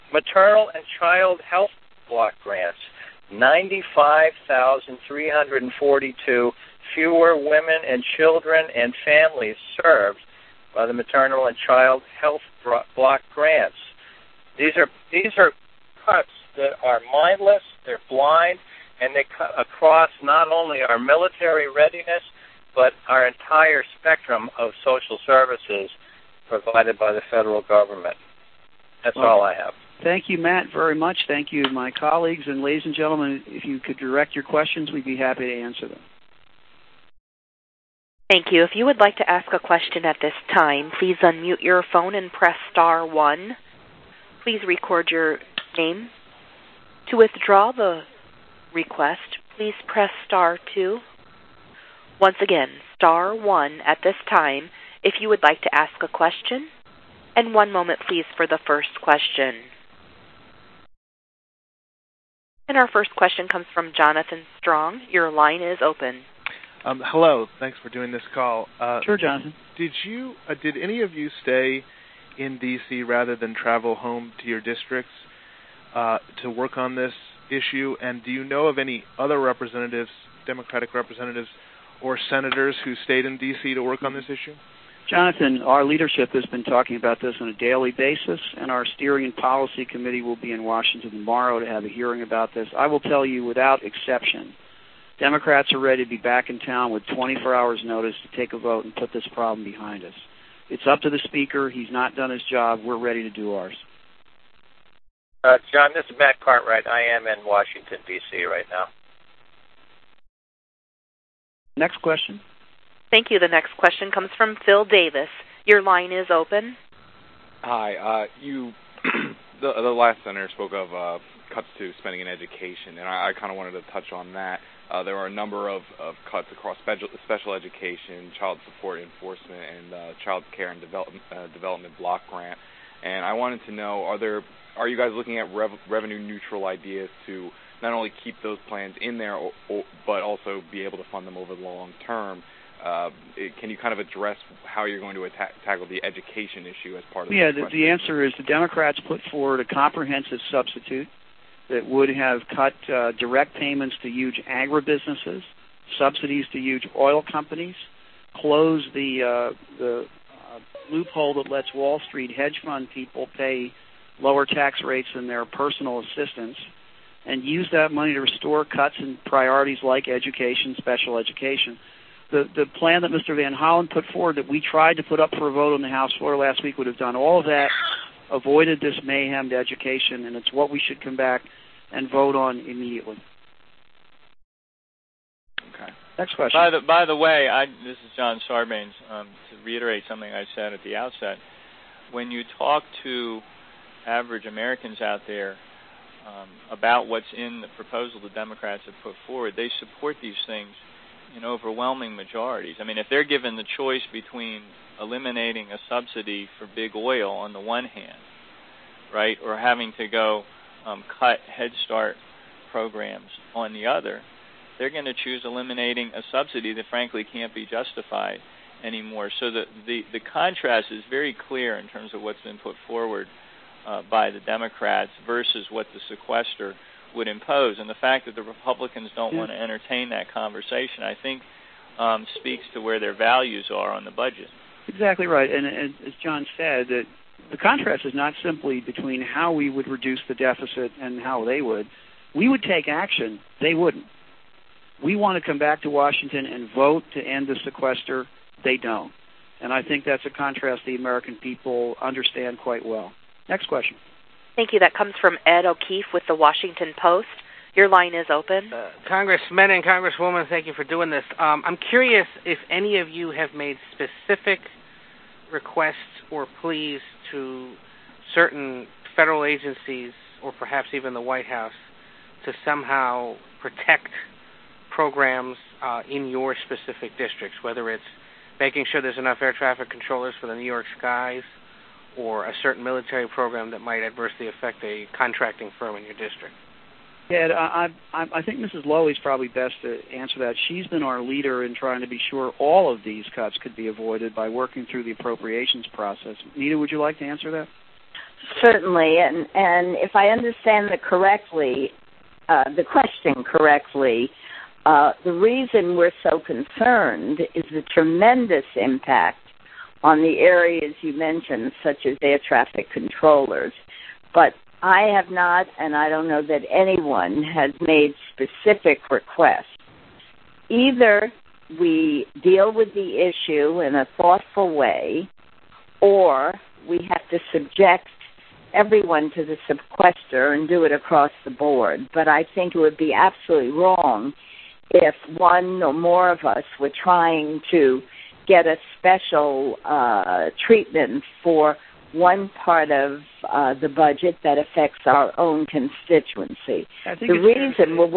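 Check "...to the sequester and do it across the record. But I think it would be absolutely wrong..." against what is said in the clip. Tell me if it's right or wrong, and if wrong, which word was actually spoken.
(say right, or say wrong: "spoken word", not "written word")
wrong: "board", not "record".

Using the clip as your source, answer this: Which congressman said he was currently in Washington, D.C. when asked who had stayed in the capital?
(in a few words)
Matt Cartwright.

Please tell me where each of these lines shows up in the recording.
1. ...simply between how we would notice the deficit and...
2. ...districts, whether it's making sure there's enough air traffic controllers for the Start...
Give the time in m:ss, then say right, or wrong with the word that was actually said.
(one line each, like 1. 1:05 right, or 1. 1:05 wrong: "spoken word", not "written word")
1. 3:58 wrong: "reduce", not "notice"
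2. 4:37 wrong: "New", not "Start".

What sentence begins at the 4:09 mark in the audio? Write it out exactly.
And I think that's a contrast the American people understand quite well.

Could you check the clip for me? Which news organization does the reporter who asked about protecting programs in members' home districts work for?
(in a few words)
Washington Post.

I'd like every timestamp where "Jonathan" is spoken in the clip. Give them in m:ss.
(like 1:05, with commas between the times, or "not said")
1:03, 1:09, 1:25.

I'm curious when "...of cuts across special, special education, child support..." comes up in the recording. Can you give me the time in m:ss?
2:05.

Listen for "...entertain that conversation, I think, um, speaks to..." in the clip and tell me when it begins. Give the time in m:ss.
3:49.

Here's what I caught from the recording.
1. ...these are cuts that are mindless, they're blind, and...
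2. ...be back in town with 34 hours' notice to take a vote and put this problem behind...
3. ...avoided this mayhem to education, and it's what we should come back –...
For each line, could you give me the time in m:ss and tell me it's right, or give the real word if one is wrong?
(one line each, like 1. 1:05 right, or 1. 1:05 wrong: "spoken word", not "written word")
1. 0:15 right
2. 1:36 wrong: "24", not "34"
3. 2:58 right.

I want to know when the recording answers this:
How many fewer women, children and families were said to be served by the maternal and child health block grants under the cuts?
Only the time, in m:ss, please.
0:03.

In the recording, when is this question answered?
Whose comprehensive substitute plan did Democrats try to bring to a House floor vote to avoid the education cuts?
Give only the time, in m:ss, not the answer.
2:53.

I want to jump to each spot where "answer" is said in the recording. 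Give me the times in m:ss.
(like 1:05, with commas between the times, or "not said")
0:35, 2:27, 4:50, 4:57.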